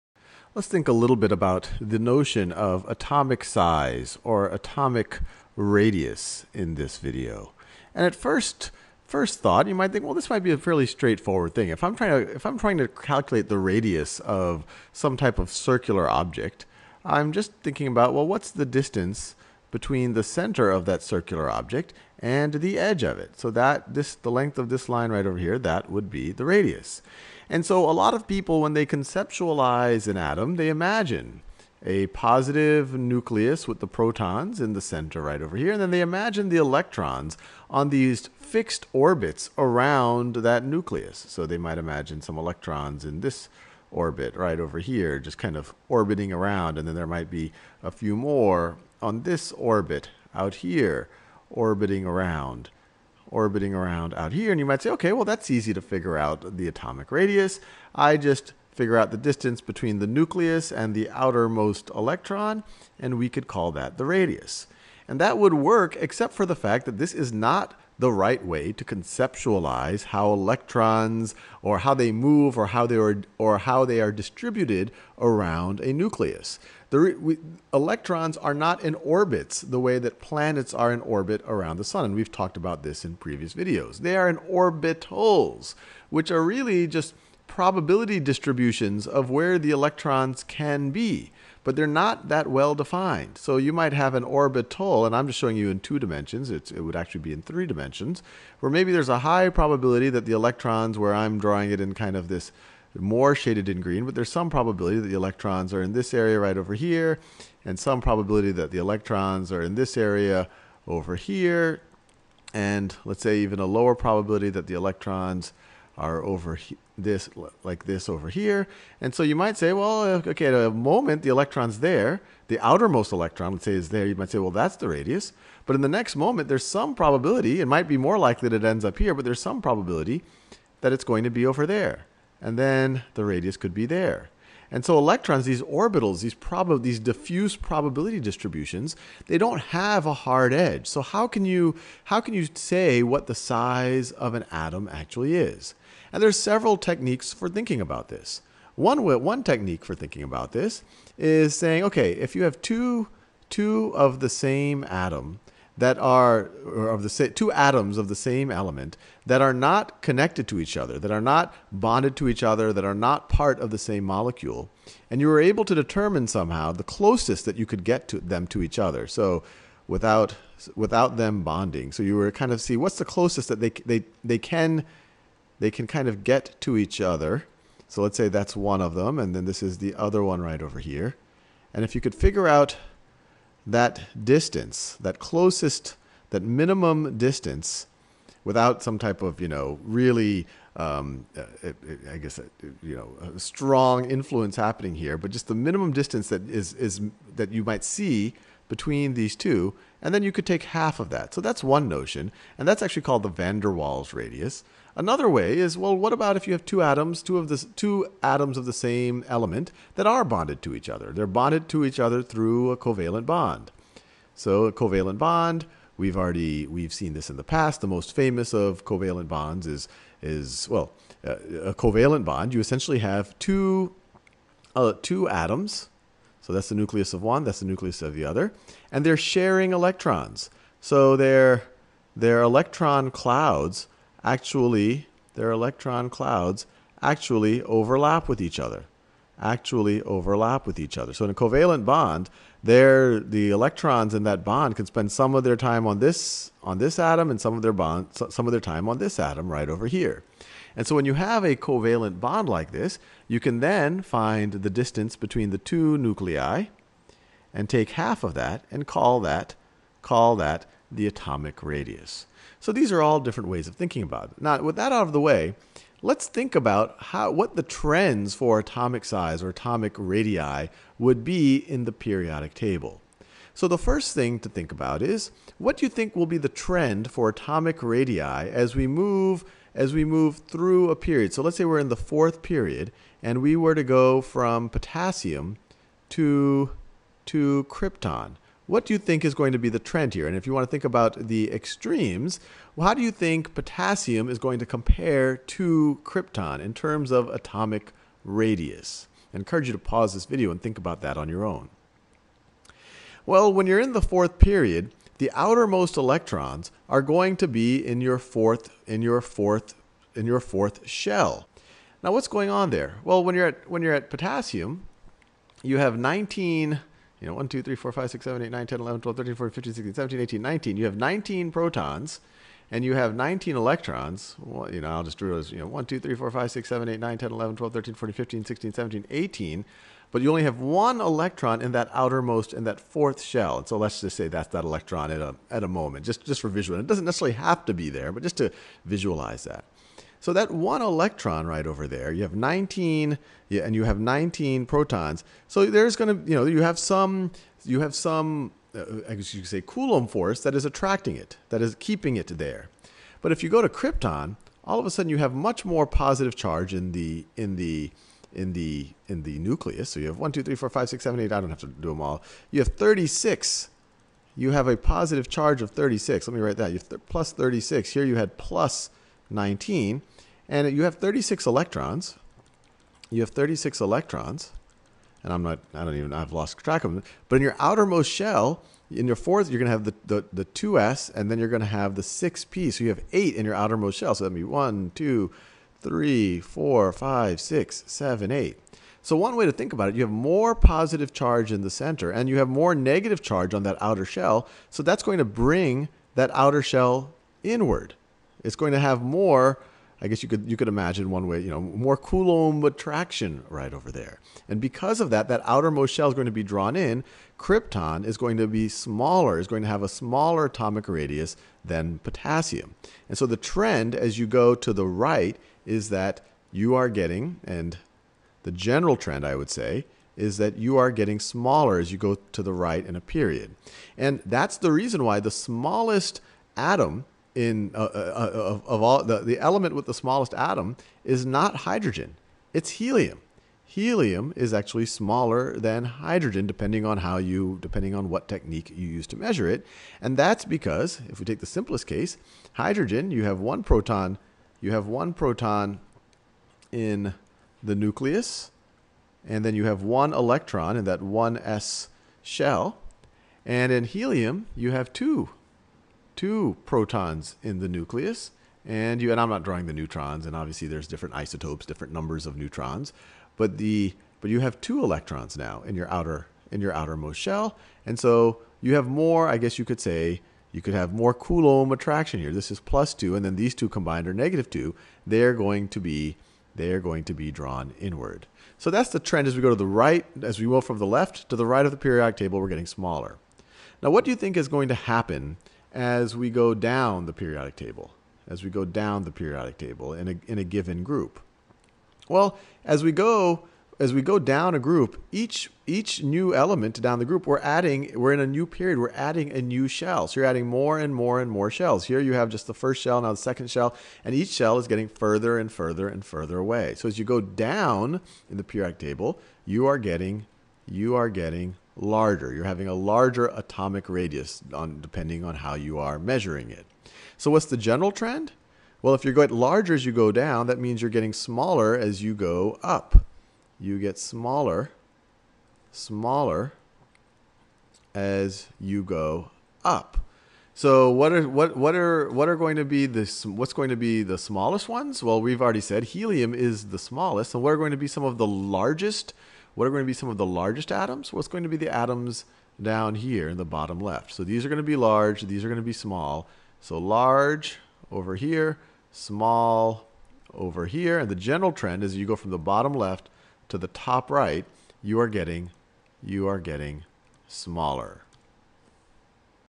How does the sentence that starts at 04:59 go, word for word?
I encourage you to pause this video and think about that on your own.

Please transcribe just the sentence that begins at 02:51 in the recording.
So you were kind of see what's the closest that they they they can they can kind of get to each other.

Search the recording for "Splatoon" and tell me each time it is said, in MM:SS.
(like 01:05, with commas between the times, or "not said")
not said.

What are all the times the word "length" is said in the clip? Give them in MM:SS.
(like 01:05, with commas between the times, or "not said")
00:24.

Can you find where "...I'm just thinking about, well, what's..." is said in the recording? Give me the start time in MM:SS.
00:17.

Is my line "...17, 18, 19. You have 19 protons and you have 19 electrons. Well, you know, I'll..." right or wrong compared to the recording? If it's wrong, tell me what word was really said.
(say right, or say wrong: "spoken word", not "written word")
right.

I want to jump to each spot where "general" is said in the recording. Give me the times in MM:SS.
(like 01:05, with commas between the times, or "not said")
06:58, 08:37, 09:11.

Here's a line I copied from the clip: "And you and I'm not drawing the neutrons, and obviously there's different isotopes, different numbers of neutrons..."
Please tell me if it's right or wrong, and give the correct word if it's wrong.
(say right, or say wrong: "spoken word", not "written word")
right.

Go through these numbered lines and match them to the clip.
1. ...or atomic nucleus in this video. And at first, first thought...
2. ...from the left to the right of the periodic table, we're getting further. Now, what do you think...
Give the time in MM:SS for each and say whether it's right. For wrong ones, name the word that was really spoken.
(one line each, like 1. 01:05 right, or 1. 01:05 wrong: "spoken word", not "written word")
1. 00:04 wrong: "radius", not "nucleus"
2. 08:00 wrong: "smaller", not "further".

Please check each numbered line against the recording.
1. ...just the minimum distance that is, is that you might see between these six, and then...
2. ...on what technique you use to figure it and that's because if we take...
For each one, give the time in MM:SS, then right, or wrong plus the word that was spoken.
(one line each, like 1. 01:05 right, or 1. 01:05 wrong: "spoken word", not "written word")
1. 03:15 wrong: "two", not "six"
2. 07:17 wrong: "measure", not "figure".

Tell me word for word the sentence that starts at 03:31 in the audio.
They're bonded to each other through a covalent bond.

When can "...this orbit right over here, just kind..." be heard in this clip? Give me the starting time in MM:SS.
00:43.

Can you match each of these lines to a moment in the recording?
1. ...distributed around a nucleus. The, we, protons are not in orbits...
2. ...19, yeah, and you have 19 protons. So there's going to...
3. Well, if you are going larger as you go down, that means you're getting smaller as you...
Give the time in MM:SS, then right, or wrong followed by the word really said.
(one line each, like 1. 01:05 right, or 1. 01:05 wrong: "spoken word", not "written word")
1. 01:14 wrong: "electrons", not "protons"
2. 05:42 right
3. 08:38 right.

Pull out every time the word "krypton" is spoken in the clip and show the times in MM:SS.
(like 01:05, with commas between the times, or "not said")
04:47, 04:56, 05:53, 06:47.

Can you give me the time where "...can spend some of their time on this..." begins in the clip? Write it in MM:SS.
04:04.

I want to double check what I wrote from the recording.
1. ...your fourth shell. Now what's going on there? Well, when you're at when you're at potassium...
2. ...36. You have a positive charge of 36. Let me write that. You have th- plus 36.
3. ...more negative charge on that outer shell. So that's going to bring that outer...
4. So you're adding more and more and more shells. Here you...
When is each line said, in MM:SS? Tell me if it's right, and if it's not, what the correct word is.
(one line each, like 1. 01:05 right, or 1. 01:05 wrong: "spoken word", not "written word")
1. 05:10 right
2. 06:02 right
3. 06:32 right
4. 08:20 right.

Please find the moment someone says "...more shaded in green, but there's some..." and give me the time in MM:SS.
01:42.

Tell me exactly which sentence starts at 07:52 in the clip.
This is plus two, and then these two combined are negative two.